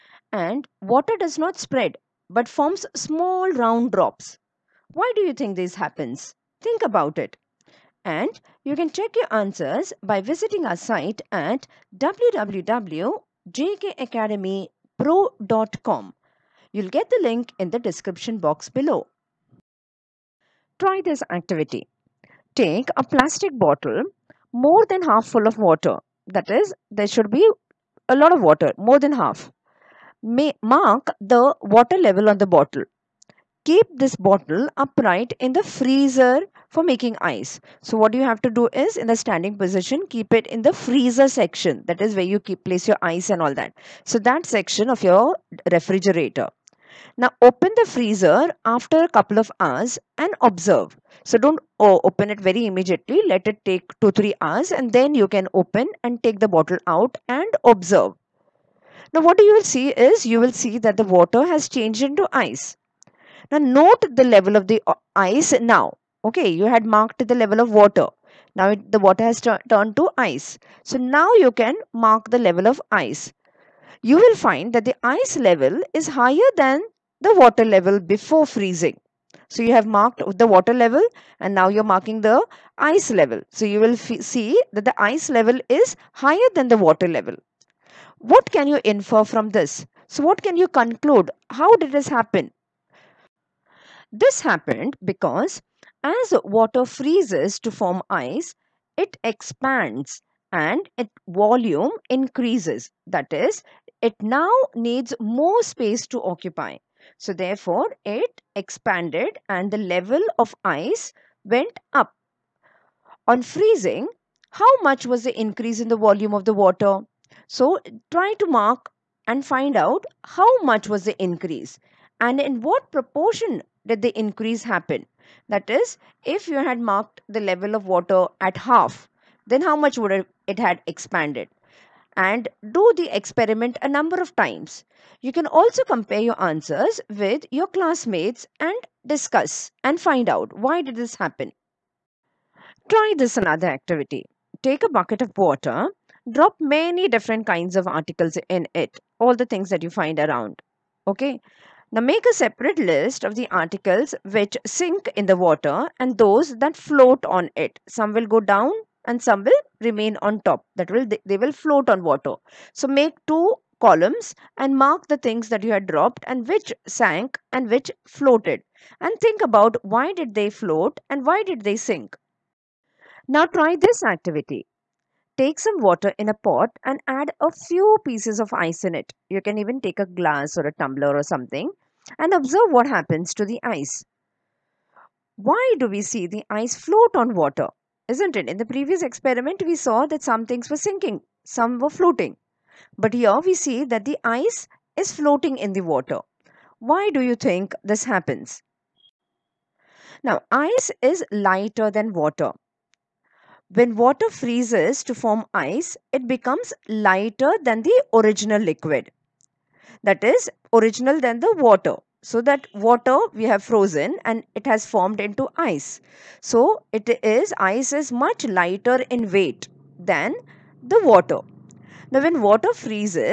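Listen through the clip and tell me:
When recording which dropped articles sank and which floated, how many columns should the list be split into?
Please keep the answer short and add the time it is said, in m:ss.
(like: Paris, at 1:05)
2, at 2:43.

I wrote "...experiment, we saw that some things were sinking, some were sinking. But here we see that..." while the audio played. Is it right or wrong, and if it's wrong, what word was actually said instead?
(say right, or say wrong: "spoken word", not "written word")
wrong: "floating", not "sinking".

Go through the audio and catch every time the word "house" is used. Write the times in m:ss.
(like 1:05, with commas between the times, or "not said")
not said.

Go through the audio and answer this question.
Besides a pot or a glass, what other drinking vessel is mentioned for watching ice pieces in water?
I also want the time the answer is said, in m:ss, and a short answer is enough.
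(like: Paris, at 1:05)
a tumbler, at 3:00.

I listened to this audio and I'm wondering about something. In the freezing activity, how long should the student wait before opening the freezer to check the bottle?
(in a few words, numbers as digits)
2-3 hours.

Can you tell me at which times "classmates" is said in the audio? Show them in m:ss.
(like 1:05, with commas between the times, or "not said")
2:17.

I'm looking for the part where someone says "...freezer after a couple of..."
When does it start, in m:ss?
0:47.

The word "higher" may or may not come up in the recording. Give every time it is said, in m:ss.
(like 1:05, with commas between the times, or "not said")
1:16, 1:26.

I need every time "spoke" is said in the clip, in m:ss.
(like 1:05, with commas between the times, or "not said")
not said.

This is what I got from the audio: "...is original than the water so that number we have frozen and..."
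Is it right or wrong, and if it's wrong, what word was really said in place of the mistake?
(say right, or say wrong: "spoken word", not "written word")
wrong: "water", not "number".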